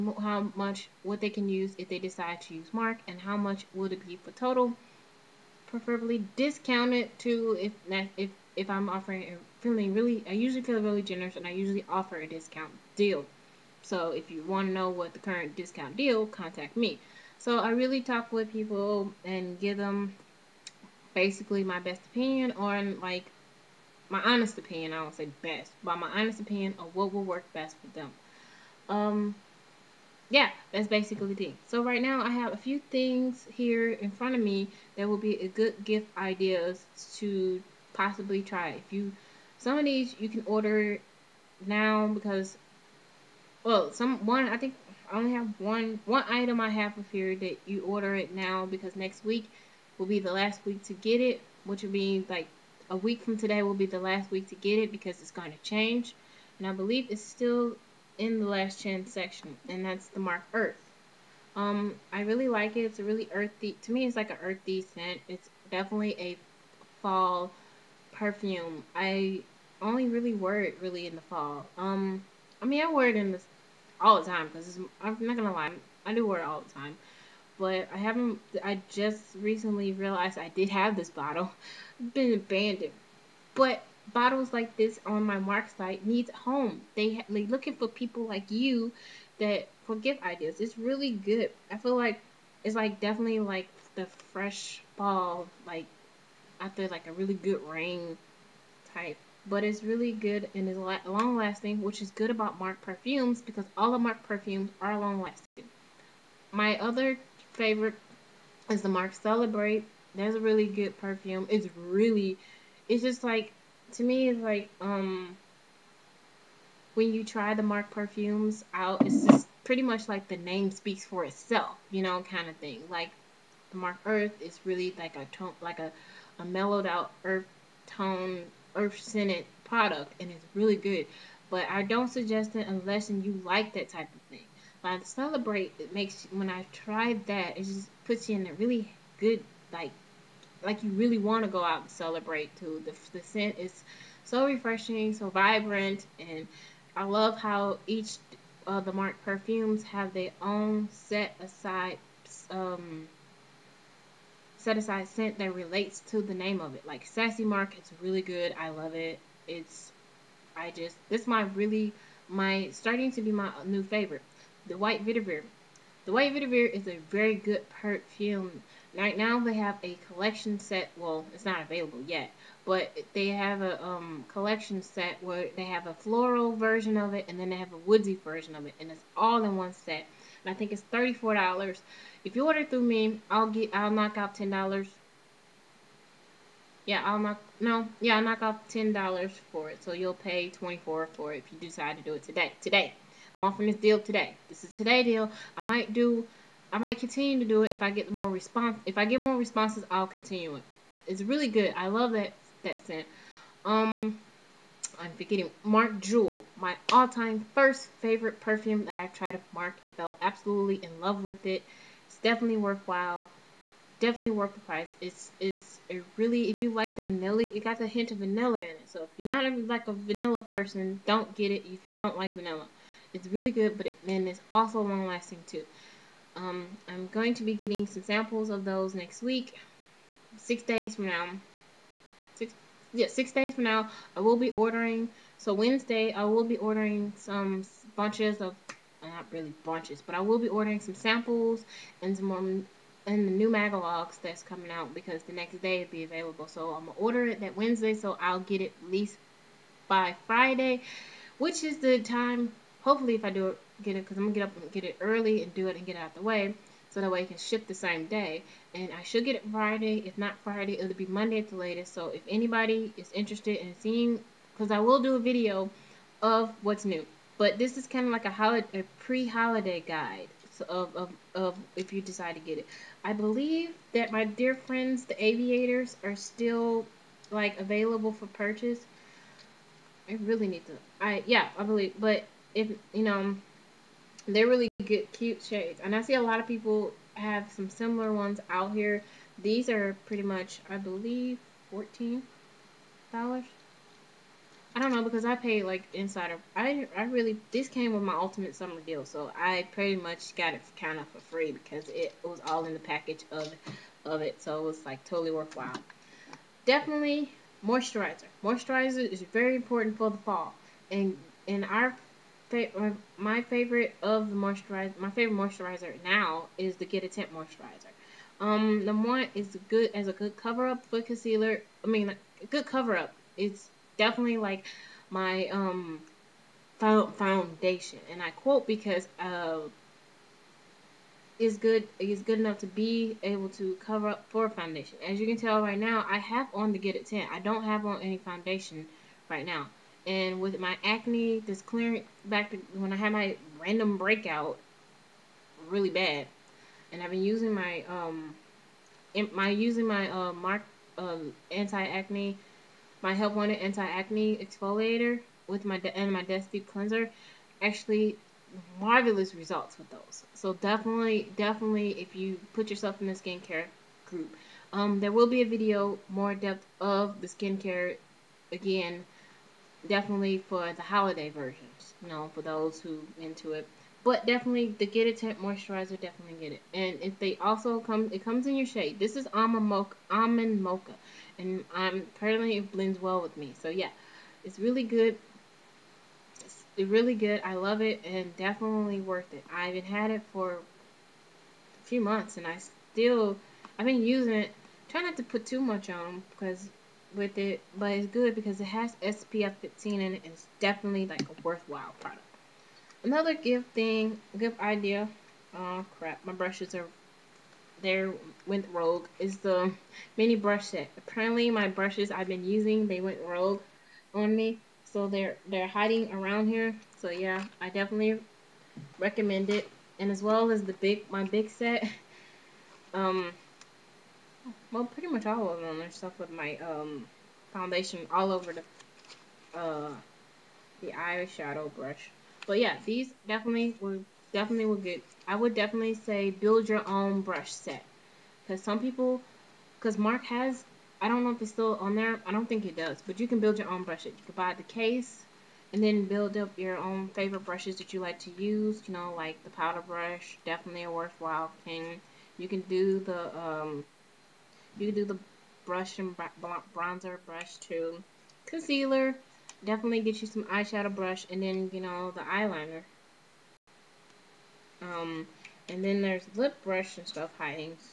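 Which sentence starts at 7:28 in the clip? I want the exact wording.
You know, like the powder brush, definitely a worthwhile thing.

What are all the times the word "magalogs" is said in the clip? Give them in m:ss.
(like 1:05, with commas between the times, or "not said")
4:03.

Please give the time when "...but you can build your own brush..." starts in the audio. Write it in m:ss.
7:23.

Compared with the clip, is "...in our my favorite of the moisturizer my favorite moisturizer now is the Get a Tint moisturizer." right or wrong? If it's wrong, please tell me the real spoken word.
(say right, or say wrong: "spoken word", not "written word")
right.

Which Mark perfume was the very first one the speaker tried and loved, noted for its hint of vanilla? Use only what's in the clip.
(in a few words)
Mark Jewel.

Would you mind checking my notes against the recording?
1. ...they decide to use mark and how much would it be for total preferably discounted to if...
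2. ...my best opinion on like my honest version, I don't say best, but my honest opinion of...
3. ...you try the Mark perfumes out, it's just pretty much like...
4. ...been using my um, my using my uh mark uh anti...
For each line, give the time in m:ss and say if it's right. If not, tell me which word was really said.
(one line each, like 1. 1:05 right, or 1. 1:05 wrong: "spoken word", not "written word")
1. 0:01 right
2. 0:21 wrong: "opinion", not "version"
3. 1:57 right
4. 5:47 right.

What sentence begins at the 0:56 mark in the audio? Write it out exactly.
And I believe it's still in the last chance section, and that's the mark Earth.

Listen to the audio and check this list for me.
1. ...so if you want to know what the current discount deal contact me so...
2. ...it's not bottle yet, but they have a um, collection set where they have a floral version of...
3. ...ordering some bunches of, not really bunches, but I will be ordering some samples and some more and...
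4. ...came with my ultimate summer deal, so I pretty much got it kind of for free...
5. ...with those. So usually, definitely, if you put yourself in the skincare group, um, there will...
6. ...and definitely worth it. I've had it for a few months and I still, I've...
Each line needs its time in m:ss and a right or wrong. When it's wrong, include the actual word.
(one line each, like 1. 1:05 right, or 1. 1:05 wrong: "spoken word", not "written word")
1. 0:13 right
2. 2:51 wrong: "available", not "bottle"
3. 3:56 right
4. 4:57 right
5. 5:59 wrong: "definitely", not "usually"
6. 6:28 right.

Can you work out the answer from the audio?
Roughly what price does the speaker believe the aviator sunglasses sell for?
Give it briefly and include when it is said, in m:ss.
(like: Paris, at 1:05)
$14, at 4:51.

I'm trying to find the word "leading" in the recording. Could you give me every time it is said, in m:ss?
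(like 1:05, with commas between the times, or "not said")
not said.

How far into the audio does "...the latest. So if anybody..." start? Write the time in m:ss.
4:21.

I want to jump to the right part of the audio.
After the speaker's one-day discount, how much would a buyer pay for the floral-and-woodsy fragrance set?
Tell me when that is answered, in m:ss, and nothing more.
3:10.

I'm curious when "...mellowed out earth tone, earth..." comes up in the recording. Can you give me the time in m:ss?
2:06.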